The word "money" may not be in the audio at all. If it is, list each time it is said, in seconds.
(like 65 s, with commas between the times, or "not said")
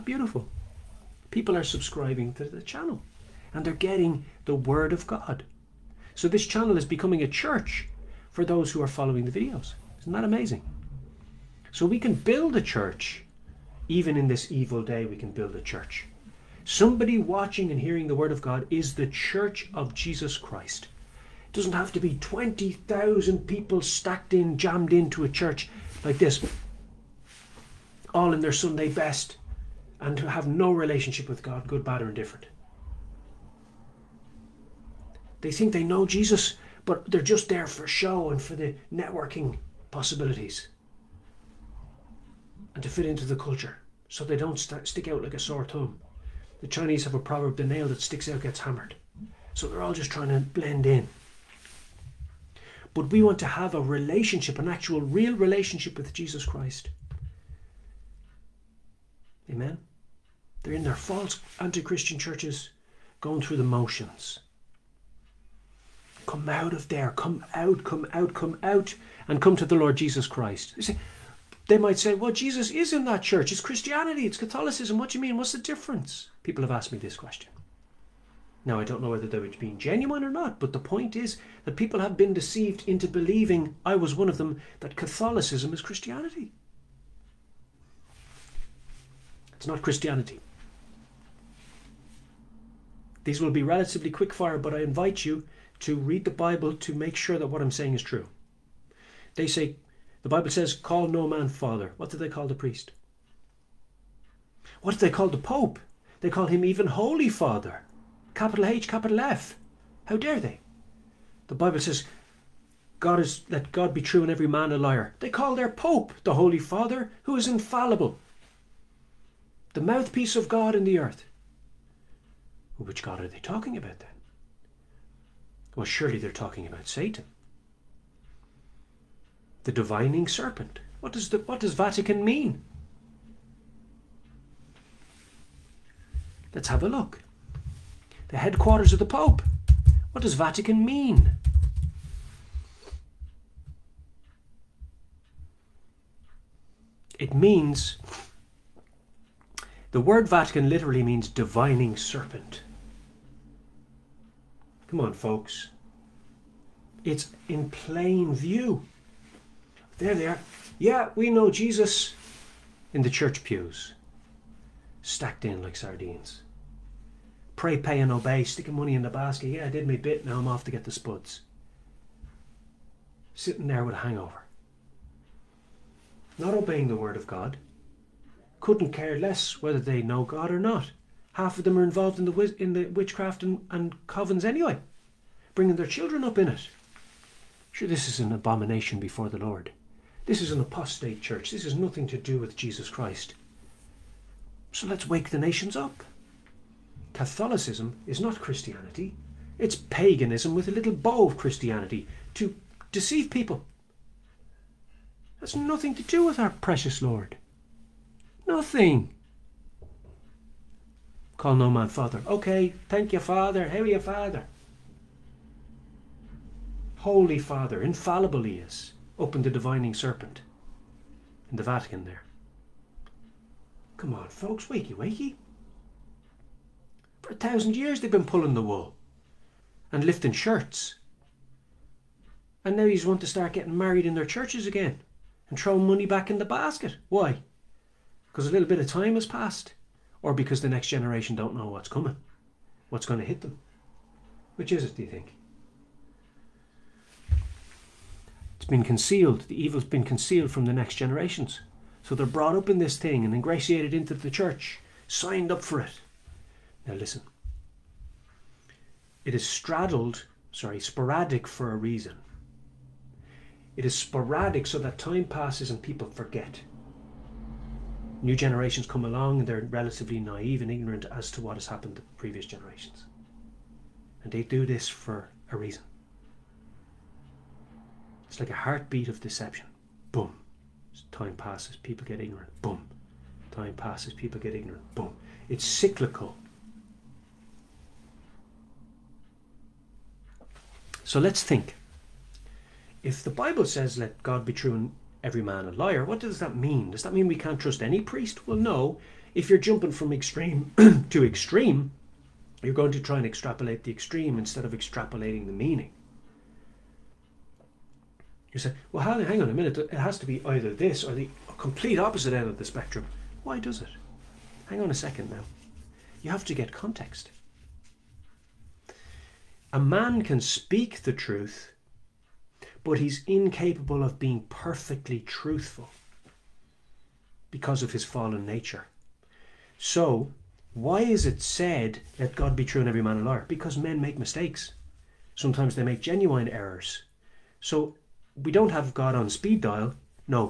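168 s, 235 s.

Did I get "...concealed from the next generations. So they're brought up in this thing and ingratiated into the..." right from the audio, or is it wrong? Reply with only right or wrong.
right.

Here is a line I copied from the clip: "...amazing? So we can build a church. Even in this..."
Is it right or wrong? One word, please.
right.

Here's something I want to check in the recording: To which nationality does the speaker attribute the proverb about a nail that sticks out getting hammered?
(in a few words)
Chinese.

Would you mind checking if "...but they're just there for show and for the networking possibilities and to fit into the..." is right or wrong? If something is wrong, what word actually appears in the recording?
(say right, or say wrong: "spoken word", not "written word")
right.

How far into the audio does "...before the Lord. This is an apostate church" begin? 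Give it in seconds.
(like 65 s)
188 s.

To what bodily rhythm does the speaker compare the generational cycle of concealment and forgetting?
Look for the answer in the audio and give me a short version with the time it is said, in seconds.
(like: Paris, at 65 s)
heartbeat, at 278 s.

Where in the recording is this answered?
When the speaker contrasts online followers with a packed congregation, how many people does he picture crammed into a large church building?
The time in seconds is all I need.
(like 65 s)
22 s.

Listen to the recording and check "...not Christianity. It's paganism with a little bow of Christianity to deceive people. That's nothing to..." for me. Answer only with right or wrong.
right.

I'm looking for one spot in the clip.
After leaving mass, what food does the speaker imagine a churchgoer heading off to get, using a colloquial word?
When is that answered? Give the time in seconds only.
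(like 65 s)
170 s.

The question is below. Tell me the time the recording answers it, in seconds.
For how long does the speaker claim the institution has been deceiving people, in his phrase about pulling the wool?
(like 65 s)
227 s.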